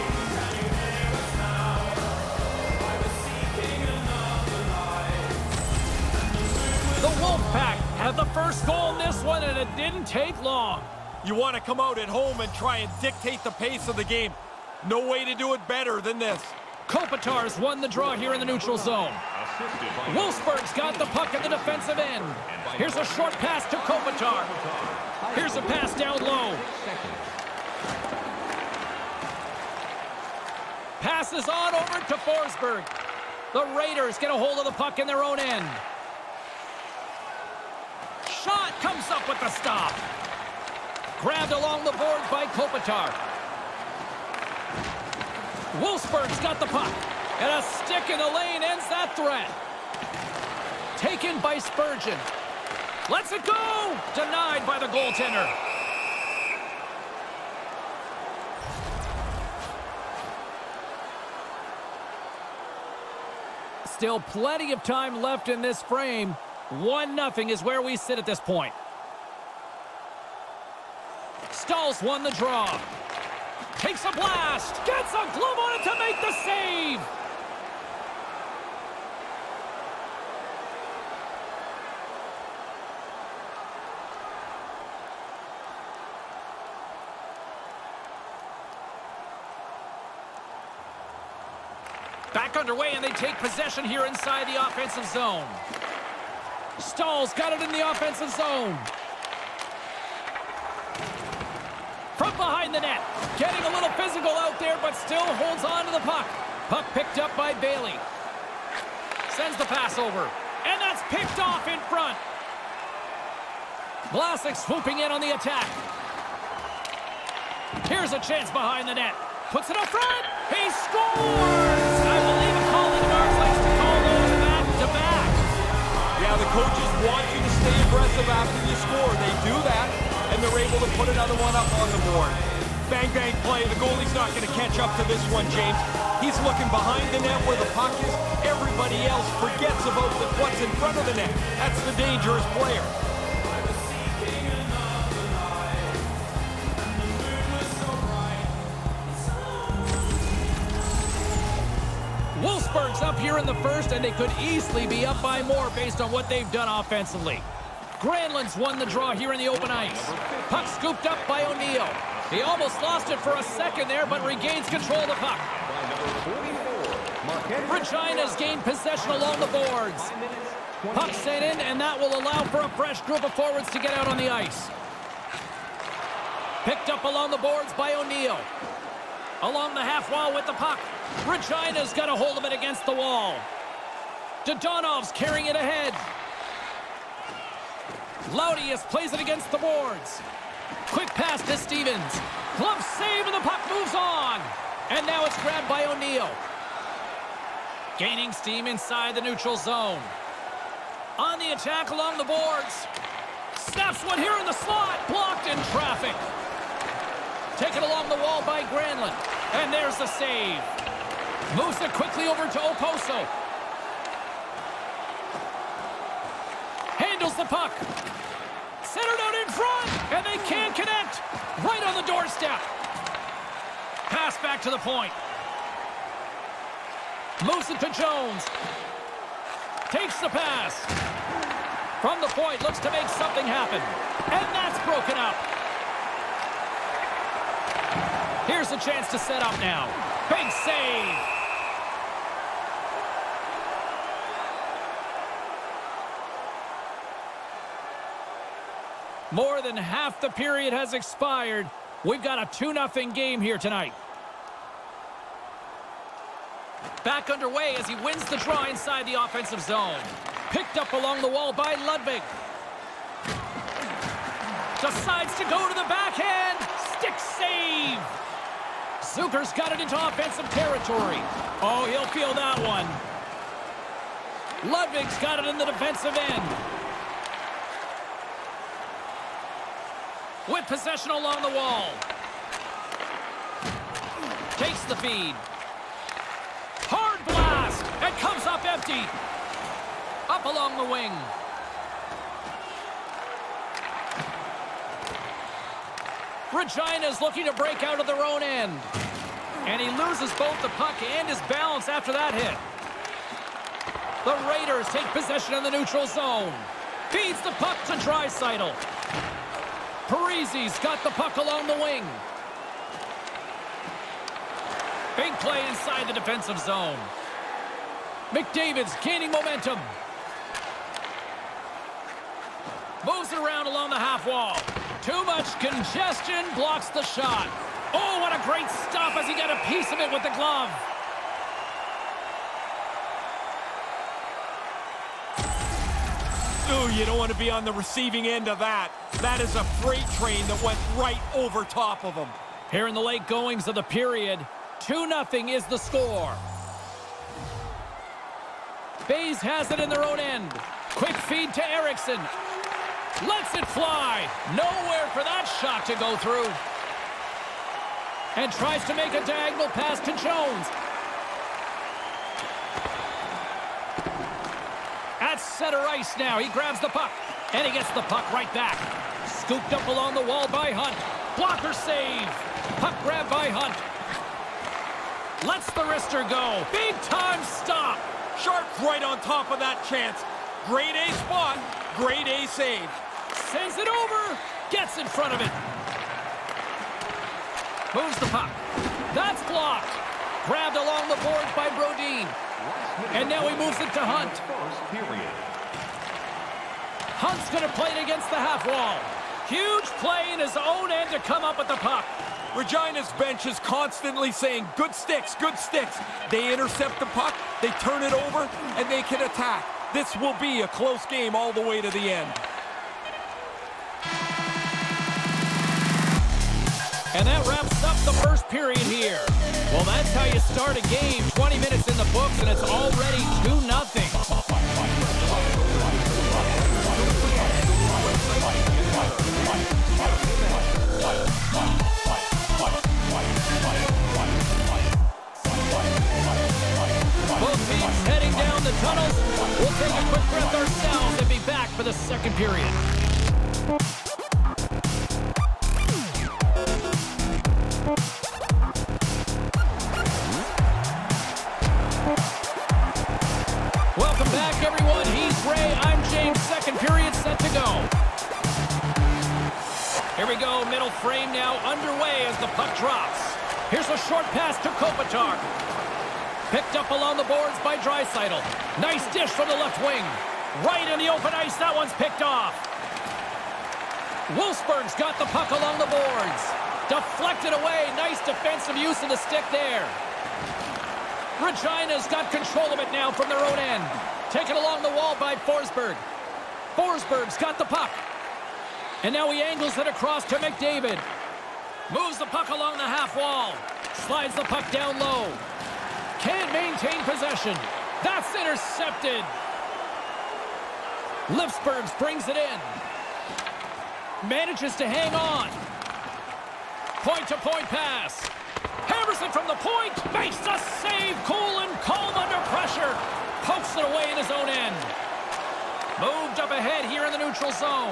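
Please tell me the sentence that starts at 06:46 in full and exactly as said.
They intercept the puck, they turn it over, and they can attack.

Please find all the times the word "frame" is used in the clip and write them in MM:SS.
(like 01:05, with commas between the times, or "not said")
01:05, 07:41.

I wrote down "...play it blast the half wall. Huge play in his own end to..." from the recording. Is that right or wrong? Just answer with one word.
wrong.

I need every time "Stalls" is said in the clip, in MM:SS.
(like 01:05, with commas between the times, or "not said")
01:11, 01:36.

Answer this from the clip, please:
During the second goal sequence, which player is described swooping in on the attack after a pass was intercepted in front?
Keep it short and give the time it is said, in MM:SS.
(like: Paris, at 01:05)
Vlasic, at 01:54.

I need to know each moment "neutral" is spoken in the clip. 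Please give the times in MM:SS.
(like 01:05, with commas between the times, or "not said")
00:18, 03:19, 05:05, 08:37.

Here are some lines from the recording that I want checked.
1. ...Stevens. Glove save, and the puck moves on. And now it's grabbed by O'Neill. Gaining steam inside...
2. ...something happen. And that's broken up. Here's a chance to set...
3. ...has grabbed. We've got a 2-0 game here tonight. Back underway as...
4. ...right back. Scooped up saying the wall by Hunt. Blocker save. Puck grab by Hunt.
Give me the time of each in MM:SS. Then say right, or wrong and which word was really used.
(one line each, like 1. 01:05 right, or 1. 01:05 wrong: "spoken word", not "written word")
1. 03:11 right
2. 03:53 right
3. 04:10 wrong: "expired", not "grabbed"
4. 06:08 wrong: "along", not "saying".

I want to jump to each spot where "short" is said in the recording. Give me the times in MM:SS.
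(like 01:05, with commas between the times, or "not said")
00:23, 07:44.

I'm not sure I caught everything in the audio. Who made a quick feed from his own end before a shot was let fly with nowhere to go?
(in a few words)
Erickson.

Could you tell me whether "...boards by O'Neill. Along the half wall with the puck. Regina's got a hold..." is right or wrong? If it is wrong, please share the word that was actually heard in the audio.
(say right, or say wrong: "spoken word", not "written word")
right.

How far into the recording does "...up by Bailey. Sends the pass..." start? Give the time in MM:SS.
01:47.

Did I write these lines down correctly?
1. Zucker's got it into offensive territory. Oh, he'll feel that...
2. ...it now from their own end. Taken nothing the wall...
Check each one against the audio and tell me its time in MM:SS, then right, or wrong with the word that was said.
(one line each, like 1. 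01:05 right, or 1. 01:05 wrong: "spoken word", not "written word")
1. 04:29 right
2. 08:02 wrong: "along", not "nothing".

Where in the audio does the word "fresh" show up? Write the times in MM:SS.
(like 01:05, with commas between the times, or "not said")
02:52.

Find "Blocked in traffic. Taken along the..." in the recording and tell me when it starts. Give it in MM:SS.
03:25.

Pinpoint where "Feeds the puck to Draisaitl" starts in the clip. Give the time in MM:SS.
05:07.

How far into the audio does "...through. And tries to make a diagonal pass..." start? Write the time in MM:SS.
05:56.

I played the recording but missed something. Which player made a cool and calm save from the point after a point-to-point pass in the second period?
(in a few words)
Harrison.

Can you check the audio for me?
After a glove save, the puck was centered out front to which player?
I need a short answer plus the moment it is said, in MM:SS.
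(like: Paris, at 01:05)
Oposo, at 03:32.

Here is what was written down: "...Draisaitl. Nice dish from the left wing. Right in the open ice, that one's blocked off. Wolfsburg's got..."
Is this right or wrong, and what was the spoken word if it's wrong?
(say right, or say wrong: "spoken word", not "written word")
wrong: "picked", not "blocked".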